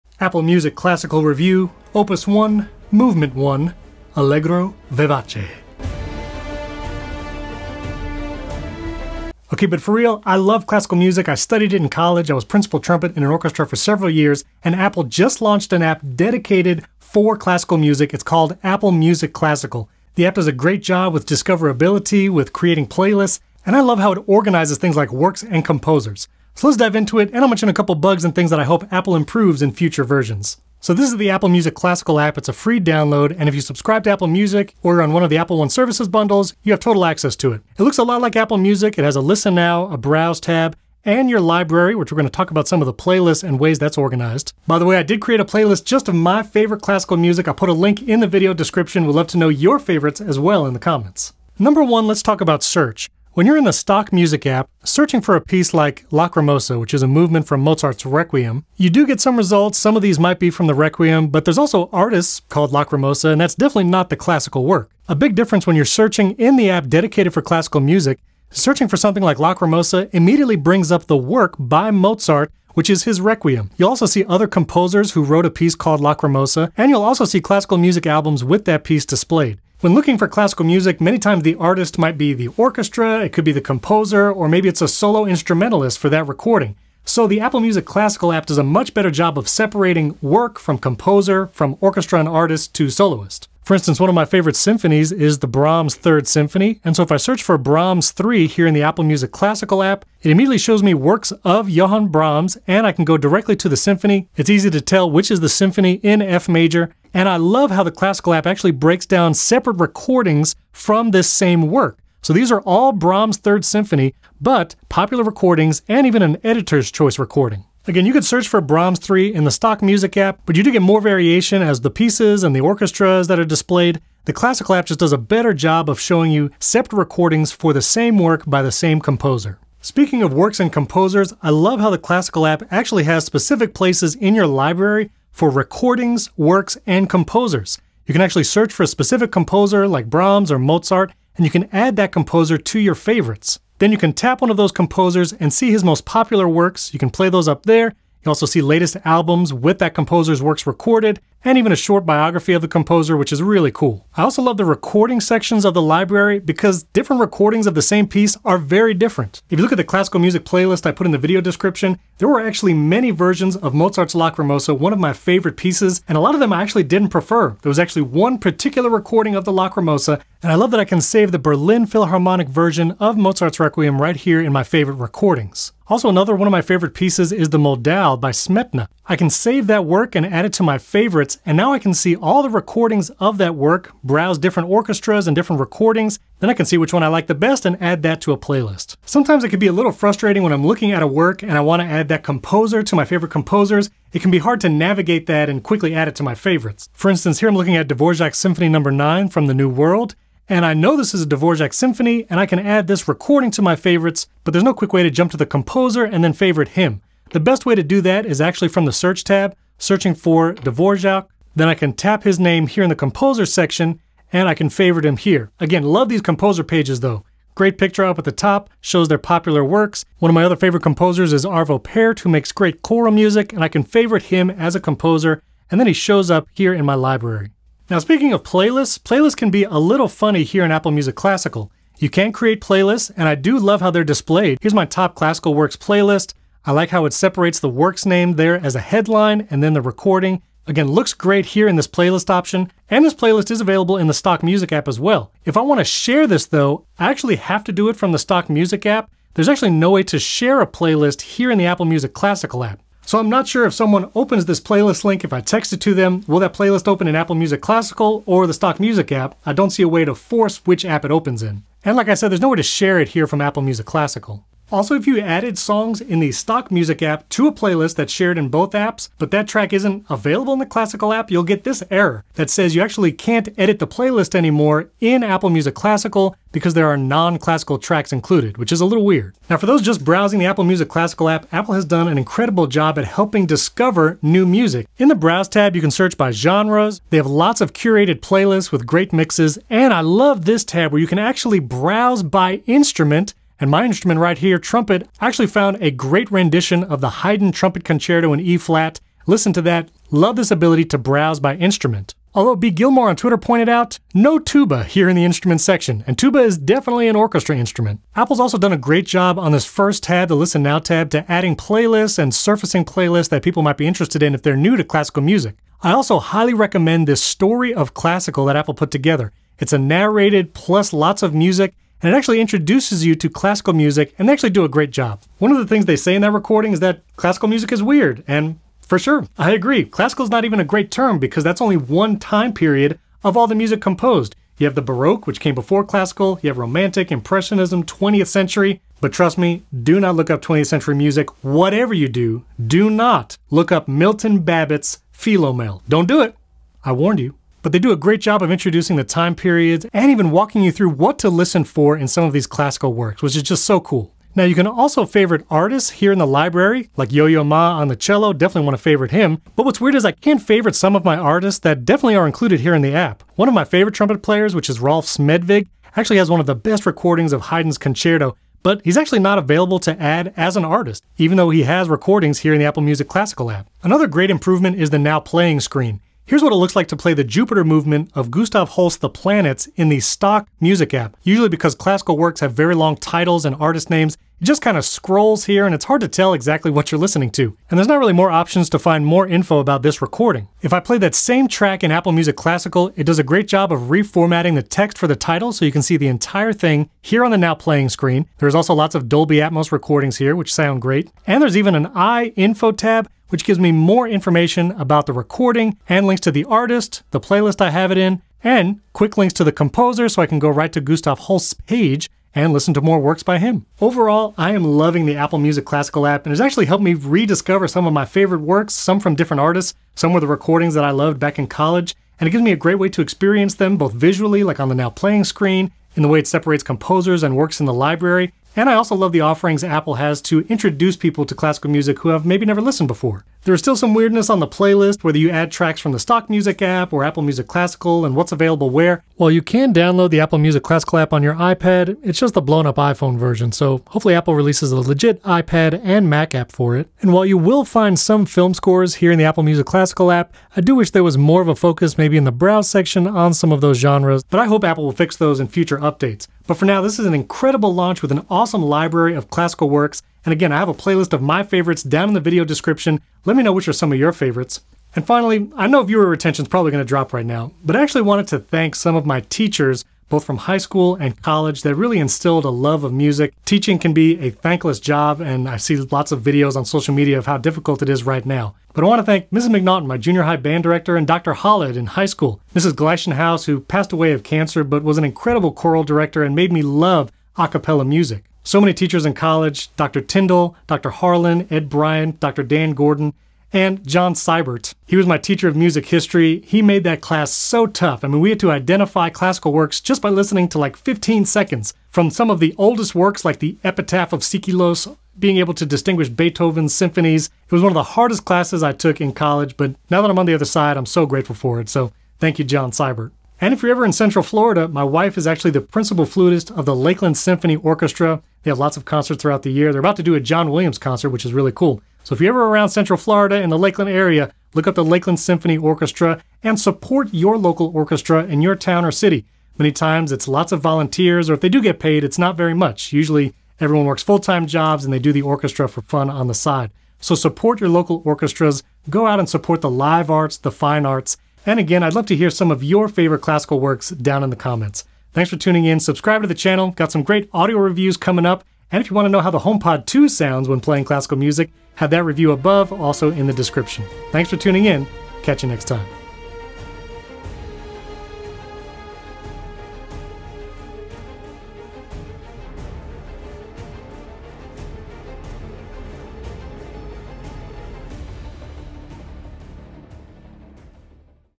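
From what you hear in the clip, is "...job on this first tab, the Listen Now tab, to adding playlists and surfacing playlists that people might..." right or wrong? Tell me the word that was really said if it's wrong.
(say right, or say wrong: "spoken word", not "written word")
right.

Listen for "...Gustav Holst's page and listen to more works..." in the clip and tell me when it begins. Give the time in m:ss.
6:50.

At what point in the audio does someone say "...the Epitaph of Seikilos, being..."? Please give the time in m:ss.
8:23.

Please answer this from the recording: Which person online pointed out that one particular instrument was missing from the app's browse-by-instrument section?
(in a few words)
B. Gilmore.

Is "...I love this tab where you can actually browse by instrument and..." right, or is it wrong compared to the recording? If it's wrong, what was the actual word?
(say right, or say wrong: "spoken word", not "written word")
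right.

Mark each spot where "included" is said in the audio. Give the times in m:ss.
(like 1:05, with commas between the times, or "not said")
4:38, 6:02.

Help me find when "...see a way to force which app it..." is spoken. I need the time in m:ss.
4:19.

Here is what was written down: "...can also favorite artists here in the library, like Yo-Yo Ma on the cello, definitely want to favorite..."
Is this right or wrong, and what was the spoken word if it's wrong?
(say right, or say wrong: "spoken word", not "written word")
right.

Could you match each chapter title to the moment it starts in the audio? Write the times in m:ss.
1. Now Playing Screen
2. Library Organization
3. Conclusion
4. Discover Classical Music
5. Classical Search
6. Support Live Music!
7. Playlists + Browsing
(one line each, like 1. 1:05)
1. 6:14
2. 2:10
3. 6:53
4. 5:07
5. 0:51
6. 7:44
7. 3:47.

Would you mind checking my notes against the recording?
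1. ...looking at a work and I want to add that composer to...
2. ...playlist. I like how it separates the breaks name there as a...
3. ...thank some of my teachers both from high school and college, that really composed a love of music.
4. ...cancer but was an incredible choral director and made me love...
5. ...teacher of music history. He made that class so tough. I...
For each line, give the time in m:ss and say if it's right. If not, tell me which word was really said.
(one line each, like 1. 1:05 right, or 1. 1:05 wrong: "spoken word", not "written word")
1. 3:10 right
2. 3:55 wrong: "works", not "breaks"
3. 7:48 wrong: "instilled", not "composed"
4. 8:04 right
5. 8:15 right.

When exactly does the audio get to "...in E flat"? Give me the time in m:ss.
4:58.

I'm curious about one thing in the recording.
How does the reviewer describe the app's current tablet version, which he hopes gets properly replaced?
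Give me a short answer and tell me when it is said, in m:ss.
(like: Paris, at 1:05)
blown up iPhone version, at 7:22.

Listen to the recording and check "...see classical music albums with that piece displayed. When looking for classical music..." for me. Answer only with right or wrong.
right.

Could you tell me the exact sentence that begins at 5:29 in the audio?
Classical is not even a great term because that's only one time period of all the music composed.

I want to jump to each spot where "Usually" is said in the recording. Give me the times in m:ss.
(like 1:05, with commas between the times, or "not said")
6:21, 8:52.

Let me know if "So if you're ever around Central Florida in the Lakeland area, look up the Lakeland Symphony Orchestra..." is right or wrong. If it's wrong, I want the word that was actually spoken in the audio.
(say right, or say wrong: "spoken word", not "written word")
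right.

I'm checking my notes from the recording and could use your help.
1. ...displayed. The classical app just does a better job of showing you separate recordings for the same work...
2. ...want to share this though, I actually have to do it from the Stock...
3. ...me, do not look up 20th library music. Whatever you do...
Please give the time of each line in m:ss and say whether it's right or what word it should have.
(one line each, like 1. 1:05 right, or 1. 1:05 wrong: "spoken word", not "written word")
1. 2:03 right
2. 4:05 right
3. 5:39 wrong: "century", not "library".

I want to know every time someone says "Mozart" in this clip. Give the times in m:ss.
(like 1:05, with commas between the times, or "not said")
0:57, 1:11, 2:20, 2:43, 2:53.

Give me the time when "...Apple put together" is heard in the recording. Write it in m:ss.
5:18.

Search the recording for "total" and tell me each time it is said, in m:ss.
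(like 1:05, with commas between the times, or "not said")
0:36.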